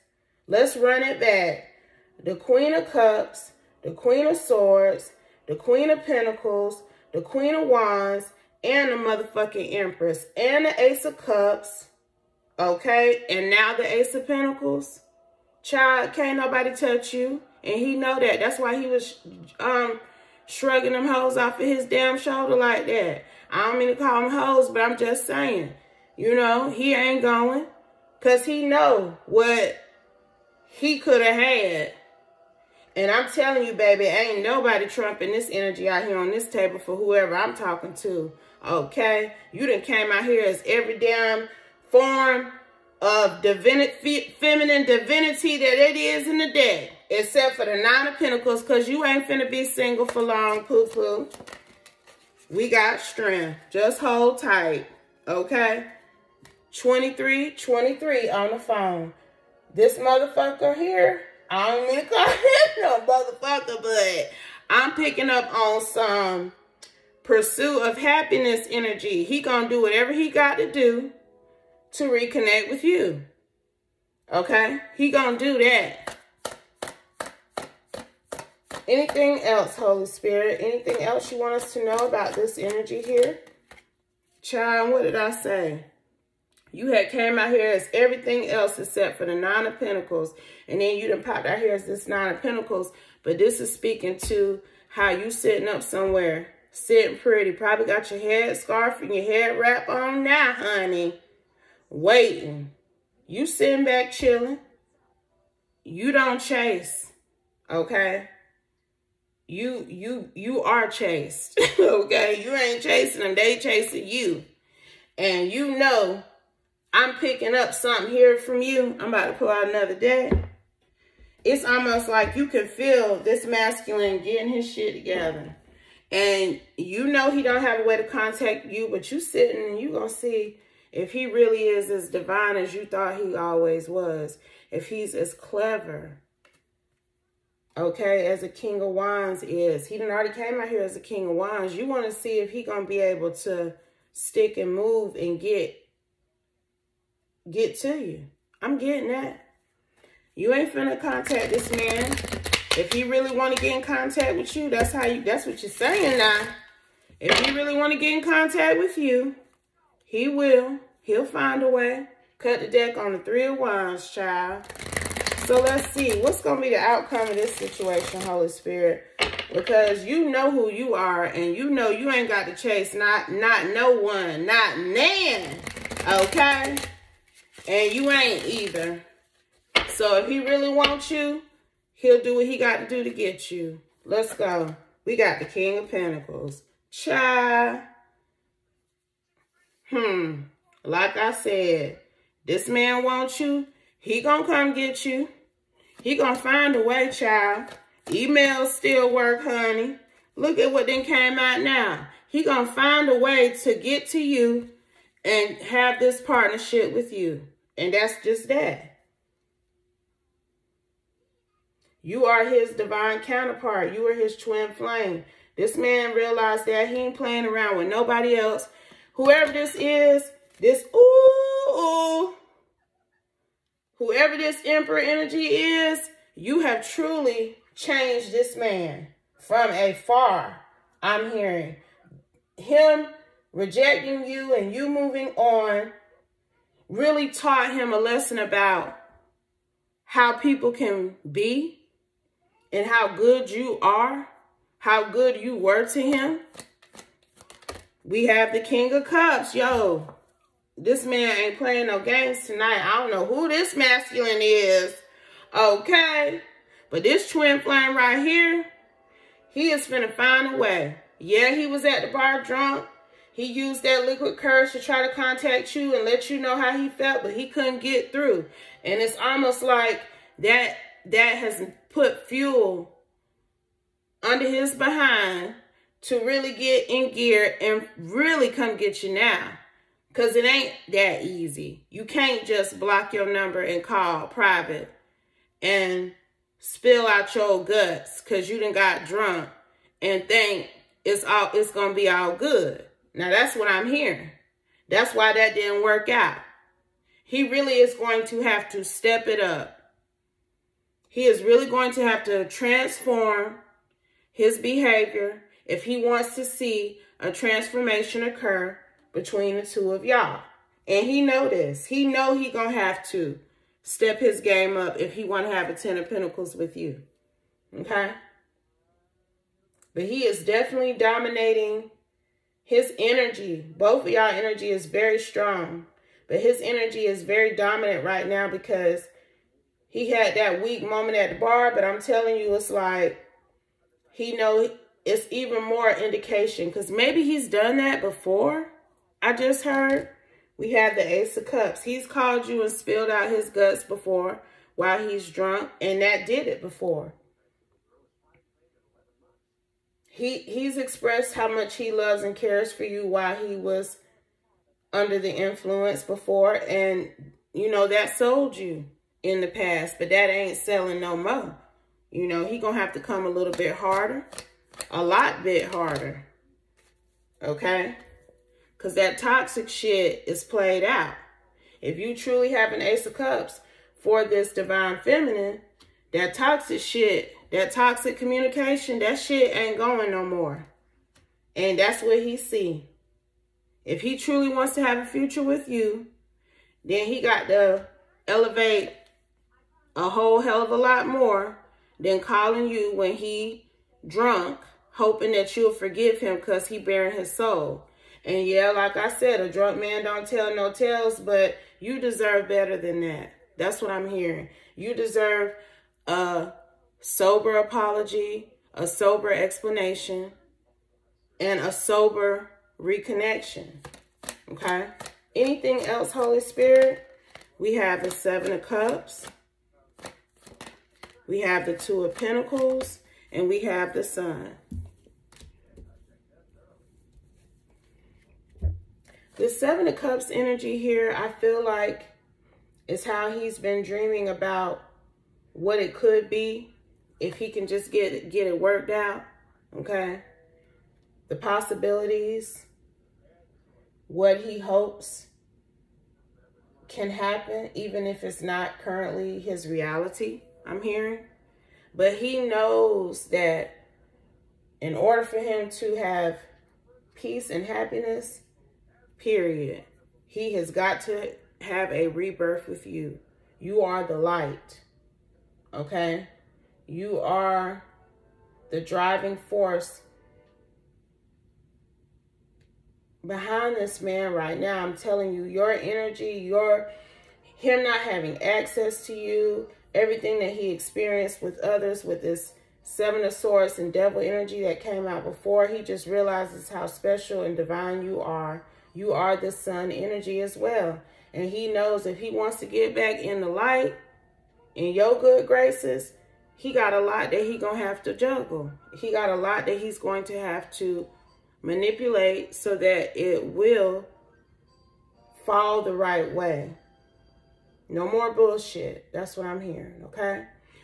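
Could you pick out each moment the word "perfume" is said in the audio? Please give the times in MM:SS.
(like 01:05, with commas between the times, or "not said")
not said.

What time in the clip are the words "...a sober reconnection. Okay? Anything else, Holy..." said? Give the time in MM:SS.
06:51.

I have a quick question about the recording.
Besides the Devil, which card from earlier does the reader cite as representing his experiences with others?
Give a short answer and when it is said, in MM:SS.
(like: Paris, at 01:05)
Seven of Swords, at 08:02.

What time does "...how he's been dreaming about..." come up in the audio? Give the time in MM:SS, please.
07:13.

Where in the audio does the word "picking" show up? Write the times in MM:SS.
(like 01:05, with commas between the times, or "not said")
01:04, 01:57.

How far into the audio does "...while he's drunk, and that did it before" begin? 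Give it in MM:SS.
05:44.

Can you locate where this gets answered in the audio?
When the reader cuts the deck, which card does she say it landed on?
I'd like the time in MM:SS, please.
02:43.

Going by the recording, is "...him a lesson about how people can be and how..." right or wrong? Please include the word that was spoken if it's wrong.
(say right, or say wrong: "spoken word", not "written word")
right.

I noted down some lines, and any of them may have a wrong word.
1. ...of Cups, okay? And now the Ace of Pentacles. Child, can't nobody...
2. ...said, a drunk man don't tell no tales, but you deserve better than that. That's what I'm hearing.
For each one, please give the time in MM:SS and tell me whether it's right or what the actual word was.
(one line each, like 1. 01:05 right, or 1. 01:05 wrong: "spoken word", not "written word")
1. 00:11 right
2. 06:39 right.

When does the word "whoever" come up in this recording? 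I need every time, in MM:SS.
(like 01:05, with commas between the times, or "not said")
00:36, 03:39, 03:43.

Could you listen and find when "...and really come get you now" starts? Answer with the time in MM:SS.
04:37.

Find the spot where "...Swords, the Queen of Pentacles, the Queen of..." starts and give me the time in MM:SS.
00:04.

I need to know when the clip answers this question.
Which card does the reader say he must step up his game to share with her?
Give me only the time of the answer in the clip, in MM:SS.
05:15.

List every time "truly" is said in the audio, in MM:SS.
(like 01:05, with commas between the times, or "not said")
03:46, 06:12, 06:24.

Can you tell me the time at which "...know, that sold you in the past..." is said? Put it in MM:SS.
05:57.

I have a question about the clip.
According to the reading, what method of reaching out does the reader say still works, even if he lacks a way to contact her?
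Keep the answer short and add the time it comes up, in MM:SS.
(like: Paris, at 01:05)
Emails, at 03:18.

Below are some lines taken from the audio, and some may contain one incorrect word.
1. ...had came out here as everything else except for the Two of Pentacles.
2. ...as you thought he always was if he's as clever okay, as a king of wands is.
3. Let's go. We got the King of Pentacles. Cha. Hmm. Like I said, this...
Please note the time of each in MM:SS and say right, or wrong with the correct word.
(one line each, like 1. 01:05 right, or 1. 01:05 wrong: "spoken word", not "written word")
1. 01:26 wrong: "Nine", not "Two"
2. 02:12 right
3. 03:04 right.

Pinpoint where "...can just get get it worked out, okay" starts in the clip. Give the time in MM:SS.
07:17.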